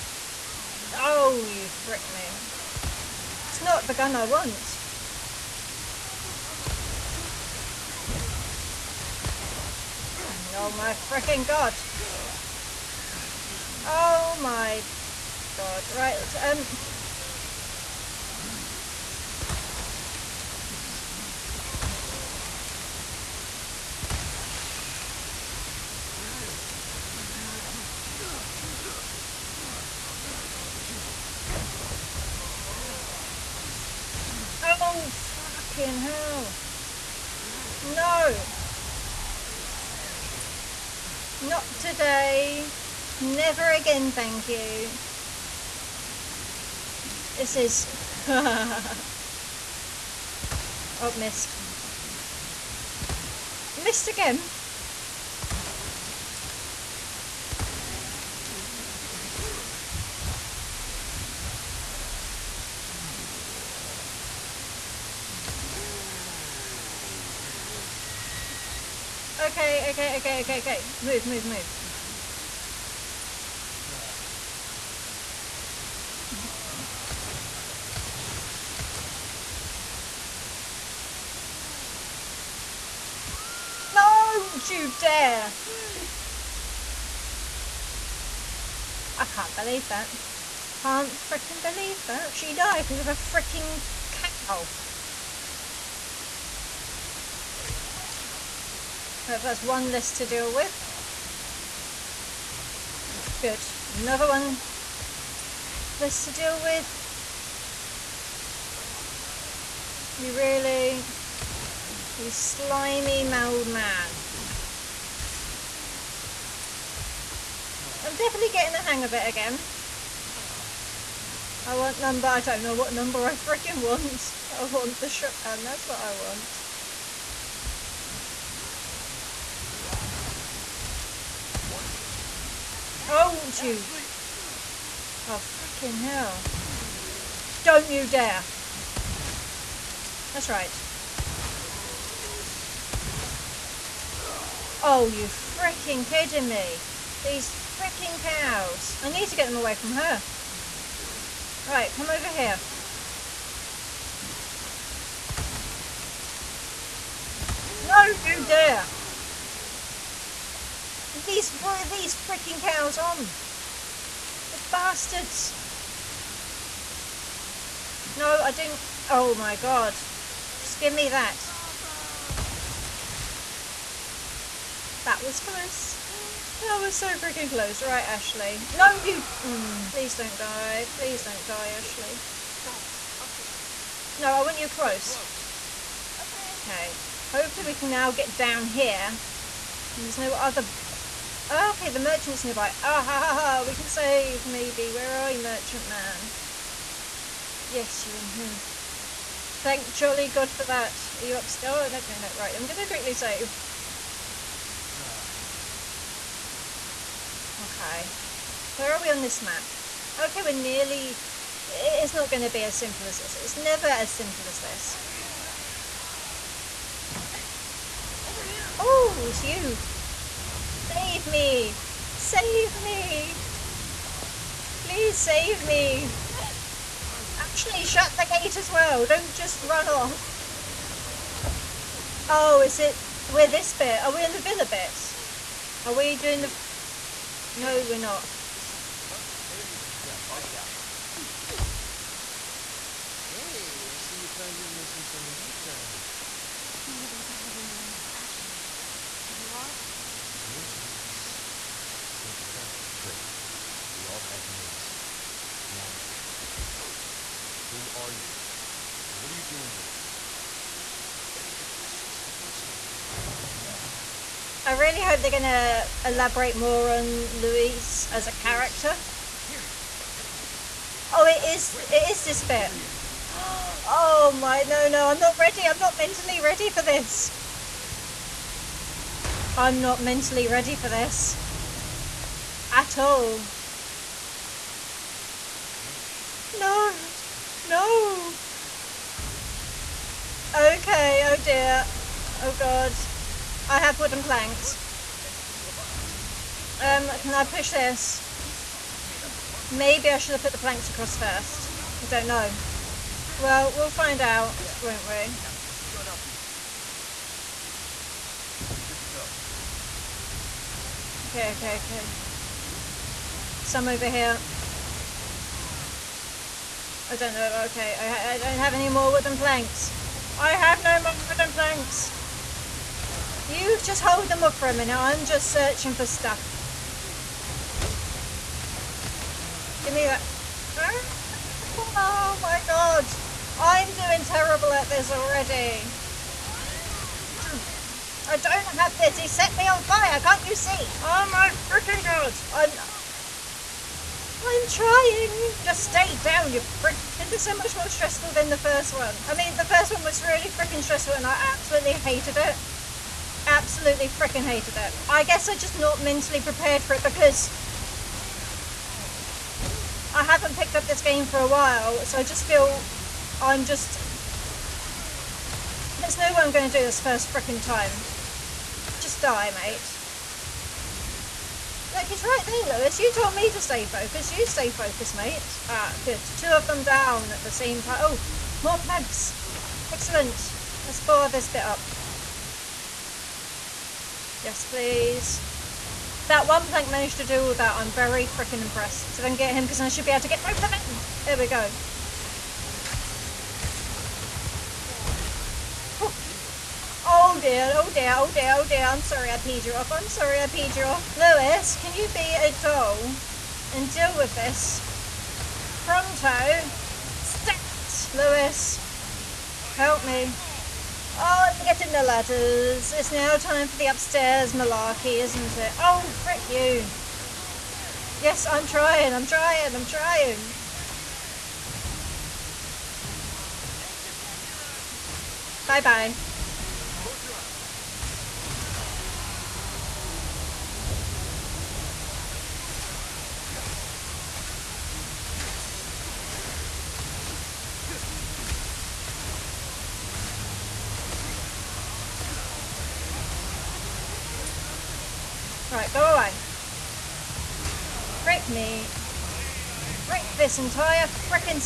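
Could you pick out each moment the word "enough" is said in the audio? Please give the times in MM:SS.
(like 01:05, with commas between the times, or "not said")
not said.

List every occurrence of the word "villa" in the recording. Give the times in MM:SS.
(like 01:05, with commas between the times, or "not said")
03:54.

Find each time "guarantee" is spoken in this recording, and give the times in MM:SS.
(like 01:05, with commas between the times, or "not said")
not said.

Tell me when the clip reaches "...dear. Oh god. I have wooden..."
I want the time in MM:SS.
04:51.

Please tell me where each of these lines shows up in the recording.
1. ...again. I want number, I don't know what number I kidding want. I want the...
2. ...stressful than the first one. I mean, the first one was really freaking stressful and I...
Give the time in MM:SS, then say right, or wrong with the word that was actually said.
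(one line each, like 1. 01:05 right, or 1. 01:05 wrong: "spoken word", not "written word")
1. 01:59 wrong: "freaking", not "kidding"
2. 05:47 right.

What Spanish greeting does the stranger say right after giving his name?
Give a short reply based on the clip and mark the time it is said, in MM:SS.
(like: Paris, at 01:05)
Encantado, at 04:12.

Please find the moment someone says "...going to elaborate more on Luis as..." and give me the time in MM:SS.
04:25.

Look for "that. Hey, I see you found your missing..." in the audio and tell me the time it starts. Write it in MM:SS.
04:00.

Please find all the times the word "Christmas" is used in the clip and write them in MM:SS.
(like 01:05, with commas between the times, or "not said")
not said.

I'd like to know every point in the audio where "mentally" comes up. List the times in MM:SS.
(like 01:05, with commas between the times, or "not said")
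04:35, 04:40, 05:56.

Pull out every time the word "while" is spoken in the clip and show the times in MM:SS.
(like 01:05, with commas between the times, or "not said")
06:01.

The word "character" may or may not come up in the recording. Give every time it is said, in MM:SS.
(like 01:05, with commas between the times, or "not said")
04:28.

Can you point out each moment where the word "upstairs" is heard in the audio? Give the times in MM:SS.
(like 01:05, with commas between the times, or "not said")
03:21, 06:53.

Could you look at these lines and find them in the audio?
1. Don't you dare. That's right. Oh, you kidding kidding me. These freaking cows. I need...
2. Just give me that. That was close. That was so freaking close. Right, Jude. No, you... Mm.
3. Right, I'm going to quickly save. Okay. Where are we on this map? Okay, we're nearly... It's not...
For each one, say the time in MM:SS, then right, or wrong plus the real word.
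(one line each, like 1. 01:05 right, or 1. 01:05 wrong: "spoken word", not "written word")
1. 02:17 wrong: "freaking", not "kidding"
2. 02:50 wrong: "Ashley", not "Jude"
3. 03:22 right.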